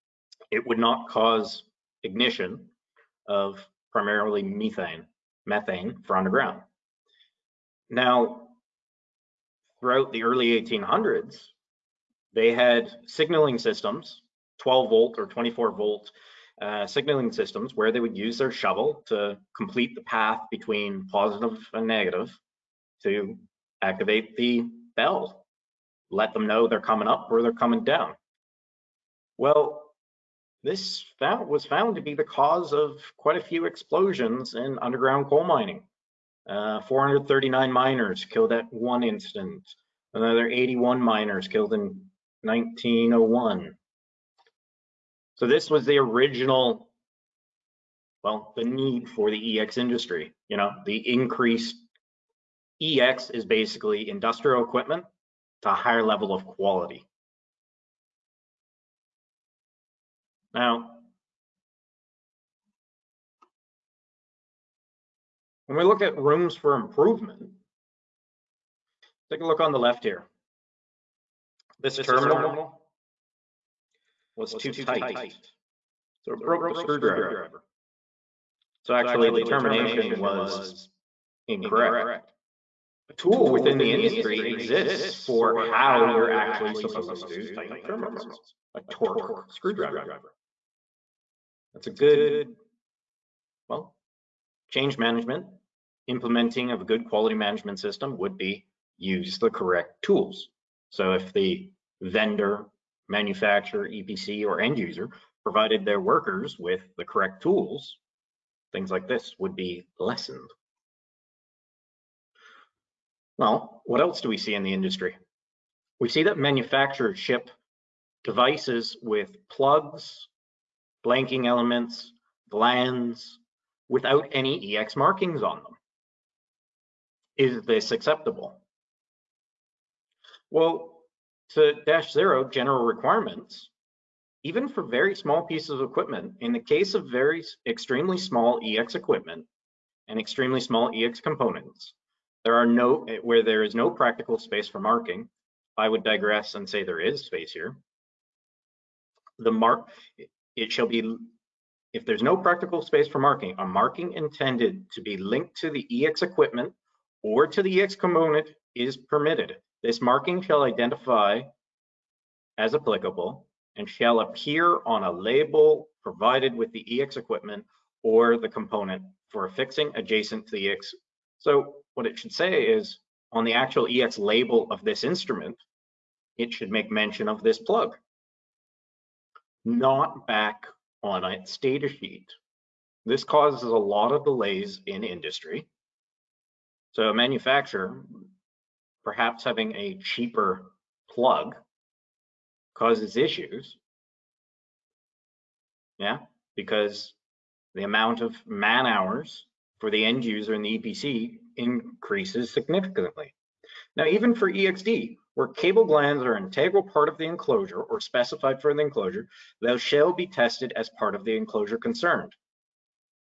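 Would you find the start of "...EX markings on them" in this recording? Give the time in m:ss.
2:04.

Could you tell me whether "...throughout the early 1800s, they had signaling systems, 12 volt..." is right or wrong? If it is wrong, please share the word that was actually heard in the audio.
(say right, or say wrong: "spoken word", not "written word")
right.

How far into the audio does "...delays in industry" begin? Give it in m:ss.
3:04.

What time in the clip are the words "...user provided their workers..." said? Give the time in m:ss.
1:44.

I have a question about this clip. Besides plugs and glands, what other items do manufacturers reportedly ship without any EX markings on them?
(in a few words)
blanking elements.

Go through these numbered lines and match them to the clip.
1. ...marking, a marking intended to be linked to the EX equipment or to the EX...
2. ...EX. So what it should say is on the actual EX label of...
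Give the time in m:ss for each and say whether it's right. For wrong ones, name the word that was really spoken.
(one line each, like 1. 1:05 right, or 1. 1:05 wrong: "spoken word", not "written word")
1. 2:33 right
2. 2:50 right.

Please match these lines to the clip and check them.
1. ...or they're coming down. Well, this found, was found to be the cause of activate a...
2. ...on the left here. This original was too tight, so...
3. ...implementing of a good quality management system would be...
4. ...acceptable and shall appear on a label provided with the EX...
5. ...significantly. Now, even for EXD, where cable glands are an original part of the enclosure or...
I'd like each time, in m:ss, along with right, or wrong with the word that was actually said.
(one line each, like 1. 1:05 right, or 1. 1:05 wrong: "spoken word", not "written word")
1. 0:27 wrong: "quite", not "activate"
2. 1:09 wrong: "terminal", not "original"
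3. 1:36 right
4. 2:42 wrong: "applicable", not "acceptable"
5. 3:22 wrong: "integral", not "original".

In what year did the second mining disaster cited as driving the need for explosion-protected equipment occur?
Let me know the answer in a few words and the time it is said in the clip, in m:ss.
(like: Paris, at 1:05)
1901, at 0:42.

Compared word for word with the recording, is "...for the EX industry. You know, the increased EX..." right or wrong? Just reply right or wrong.
right.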